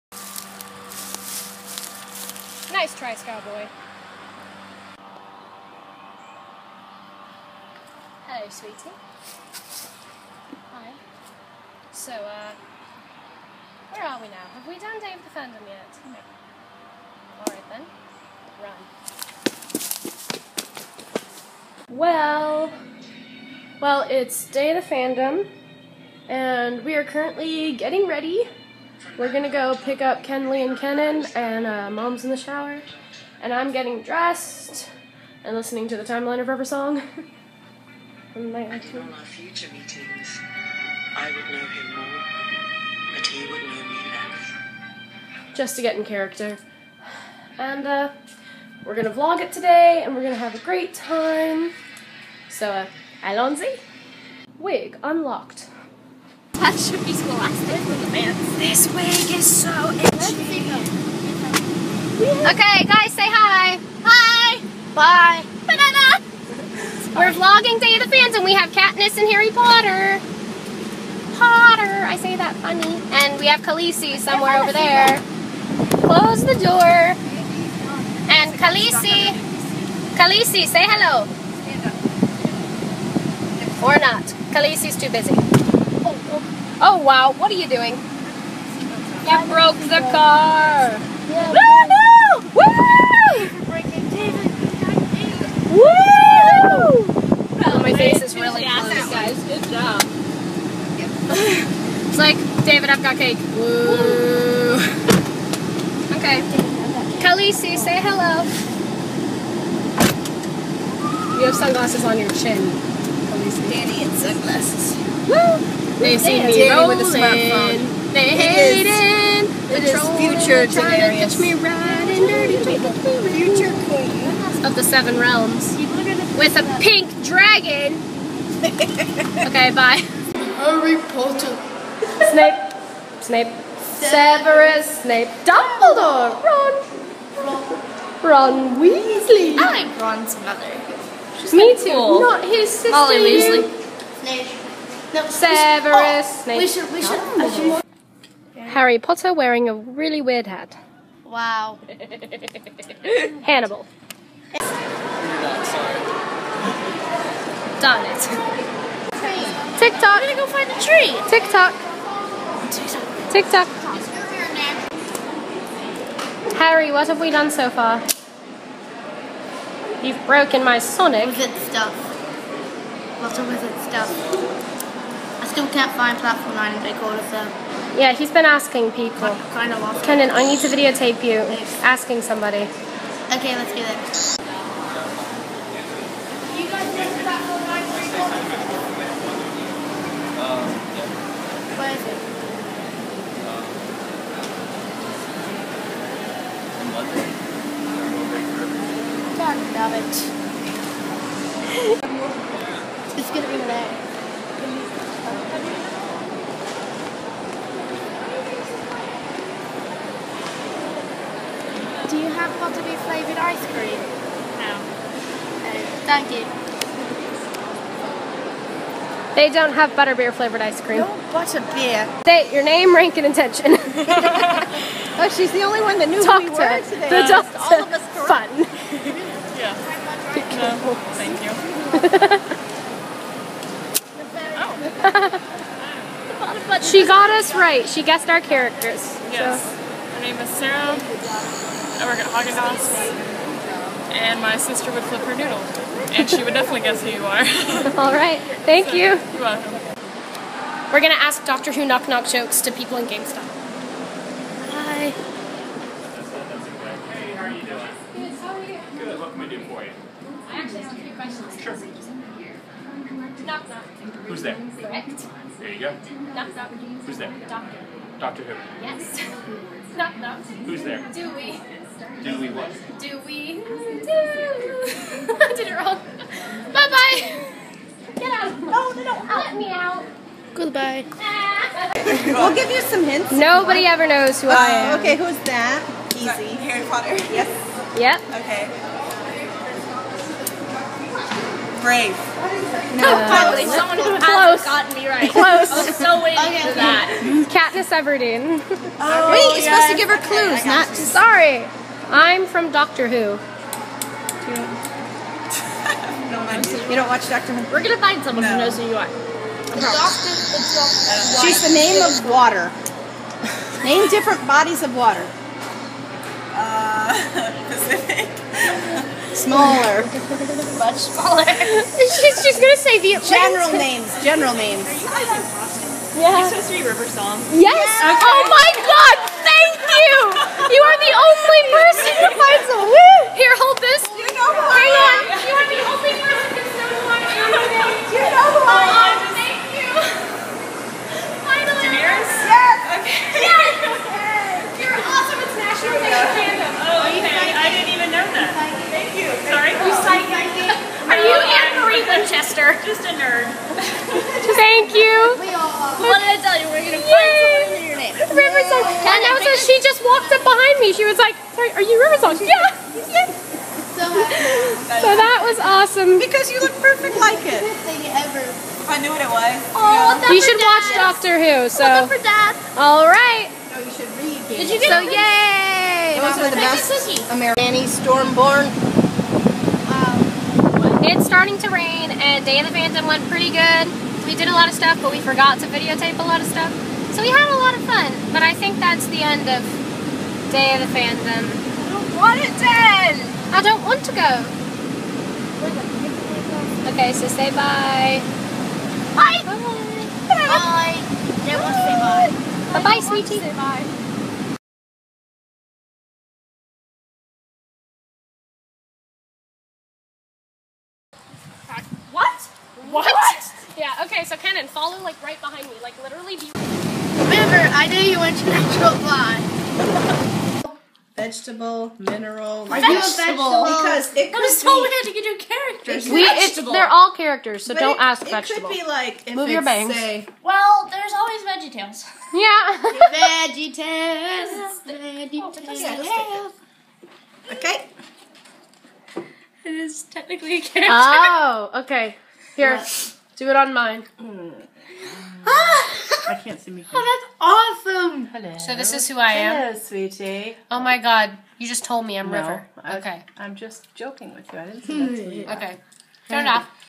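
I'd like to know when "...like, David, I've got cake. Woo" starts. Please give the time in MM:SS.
01:42.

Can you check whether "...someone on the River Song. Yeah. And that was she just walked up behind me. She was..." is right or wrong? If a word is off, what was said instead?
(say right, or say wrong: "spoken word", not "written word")
right.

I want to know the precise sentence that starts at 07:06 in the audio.
We, its they're all characters, so but don't it, ask it vegetable.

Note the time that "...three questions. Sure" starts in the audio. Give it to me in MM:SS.
04:20.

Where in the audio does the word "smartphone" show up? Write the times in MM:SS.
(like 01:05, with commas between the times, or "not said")
01:57.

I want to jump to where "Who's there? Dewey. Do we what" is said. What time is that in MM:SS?
04:30.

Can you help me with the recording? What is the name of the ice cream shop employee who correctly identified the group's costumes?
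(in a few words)
Sarah.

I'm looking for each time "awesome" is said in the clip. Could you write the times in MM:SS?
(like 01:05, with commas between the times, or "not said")
06:05, 07:27.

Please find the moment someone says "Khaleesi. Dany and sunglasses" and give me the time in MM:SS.
01:52.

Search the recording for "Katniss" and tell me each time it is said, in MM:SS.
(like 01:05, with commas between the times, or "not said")
01:08, 04:57.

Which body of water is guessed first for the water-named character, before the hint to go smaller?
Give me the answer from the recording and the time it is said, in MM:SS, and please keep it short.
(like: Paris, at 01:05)
Pacific, at 05:17.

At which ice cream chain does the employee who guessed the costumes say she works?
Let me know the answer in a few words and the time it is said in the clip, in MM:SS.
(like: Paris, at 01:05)
Haagen-Dazs, at 04:02.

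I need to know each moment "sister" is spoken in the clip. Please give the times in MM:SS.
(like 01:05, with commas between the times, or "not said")
02:22, 04:04.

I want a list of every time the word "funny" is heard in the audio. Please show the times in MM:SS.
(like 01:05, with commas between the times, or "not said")
01:12.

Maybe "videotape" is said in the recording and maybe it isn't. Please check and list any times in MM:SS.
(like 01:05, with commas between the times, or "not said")
03:00, 06:25.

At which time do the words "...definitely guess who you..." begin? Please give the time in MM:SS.
04:06.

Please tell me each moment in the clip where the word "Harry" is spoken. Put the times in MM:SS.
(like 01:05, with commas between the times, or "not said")
01:09, 02:10, 02:28, 02:46, 04:46.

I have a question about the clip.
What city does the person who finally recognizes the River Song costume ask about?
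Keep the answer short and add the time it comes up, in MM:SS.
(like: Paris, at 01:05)
Boston, at 05:25.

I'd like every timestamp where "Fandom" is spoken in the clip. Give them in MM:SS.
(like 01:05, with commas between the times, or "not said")
00:15, 00:24, 06:22, 06:30.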